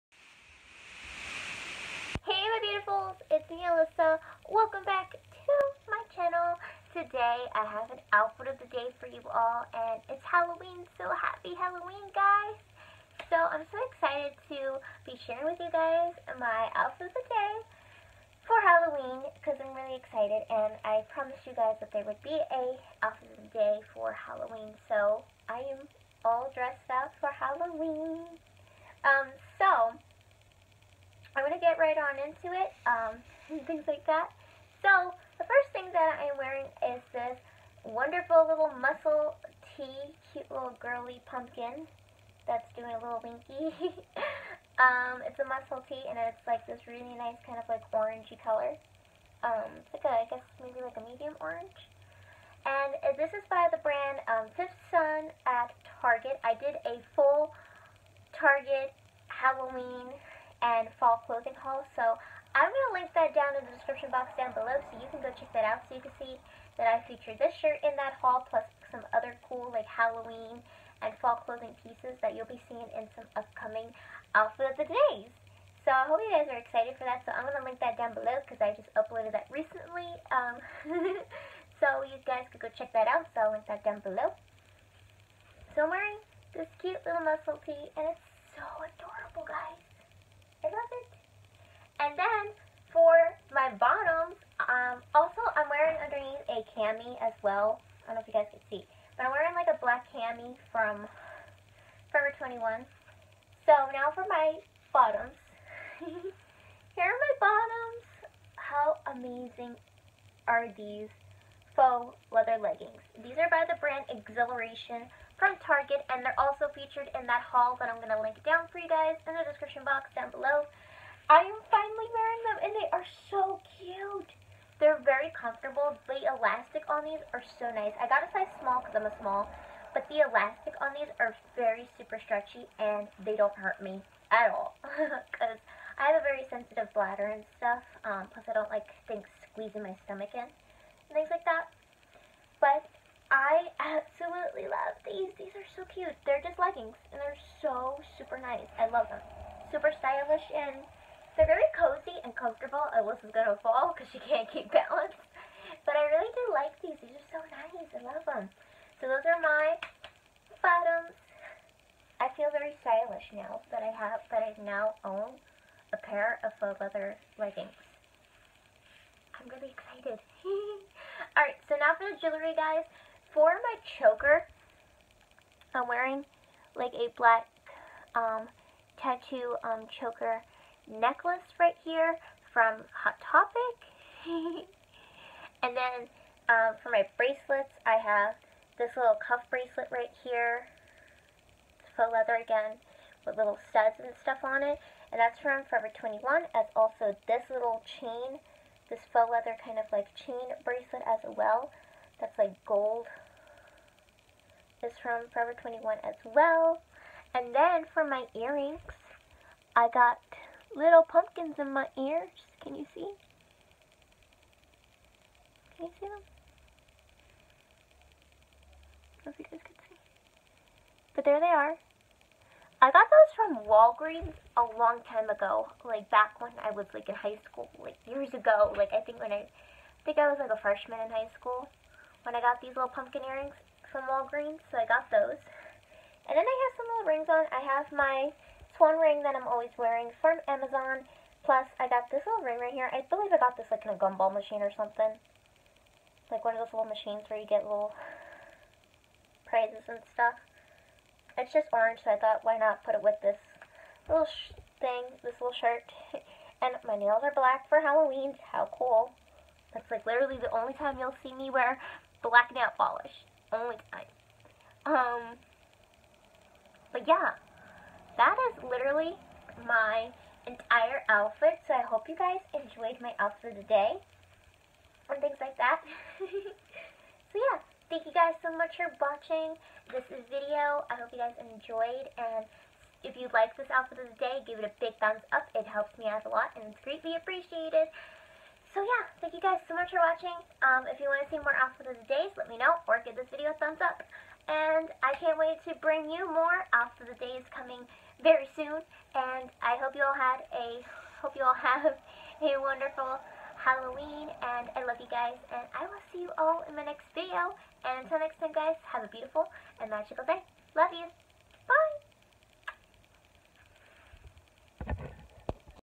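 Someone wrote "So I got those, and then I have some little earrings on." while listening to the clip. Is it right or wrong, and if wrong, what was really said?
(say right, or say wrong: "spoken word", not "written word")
wrong: "rings", not "earrings".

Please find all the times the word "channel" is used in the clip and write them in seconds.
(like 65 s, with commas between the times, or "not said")
6 s.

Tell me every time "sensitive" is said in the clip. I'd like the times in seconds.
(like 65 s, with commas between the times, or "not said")
136 s.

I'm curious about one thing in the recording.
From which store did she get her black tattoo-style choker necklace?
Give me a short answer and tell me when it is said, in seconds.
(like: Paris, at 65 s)
Hot Topic, at 182 s.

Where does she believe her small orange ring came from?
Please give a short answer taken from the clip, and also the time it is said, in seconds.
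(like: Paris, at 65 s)
a gumball machine, at 244 s.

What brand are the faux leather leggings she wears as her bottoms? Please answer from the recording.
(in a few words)
Xhiliration.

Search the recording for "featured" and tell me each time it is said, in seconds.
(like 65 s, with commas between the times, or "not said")
67 s, 116 s.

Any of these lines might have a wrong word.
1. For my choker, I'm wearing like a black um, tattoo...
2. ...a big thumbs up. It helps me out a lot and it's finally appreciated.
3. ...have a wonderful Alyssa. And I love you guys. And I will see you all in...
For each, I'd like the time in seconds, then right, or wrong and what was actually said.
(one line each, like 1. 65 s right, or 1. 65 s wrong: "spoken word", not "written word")
1. 173 s right
2. 284 s wrong: "greatly", not "finally"
3. 301 s wrong: "Halloween", not "Alyssa".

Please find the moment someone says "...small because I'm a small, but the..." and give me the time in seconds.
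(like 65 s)
128 s.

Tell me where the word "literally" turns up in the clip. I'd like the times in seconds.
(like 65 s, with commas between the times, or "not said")
260 s, 268 s.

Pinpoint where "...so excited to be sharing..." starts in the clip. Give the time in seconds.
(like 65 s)
13 s.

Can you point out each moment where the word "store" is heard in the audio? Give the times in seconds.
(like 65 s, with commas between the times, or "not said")
not said.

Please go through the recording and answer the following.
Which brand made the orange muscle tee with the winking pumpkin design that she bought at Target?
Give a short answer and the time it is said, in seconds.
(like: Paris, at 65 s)
Fifth Sun, at 54 s.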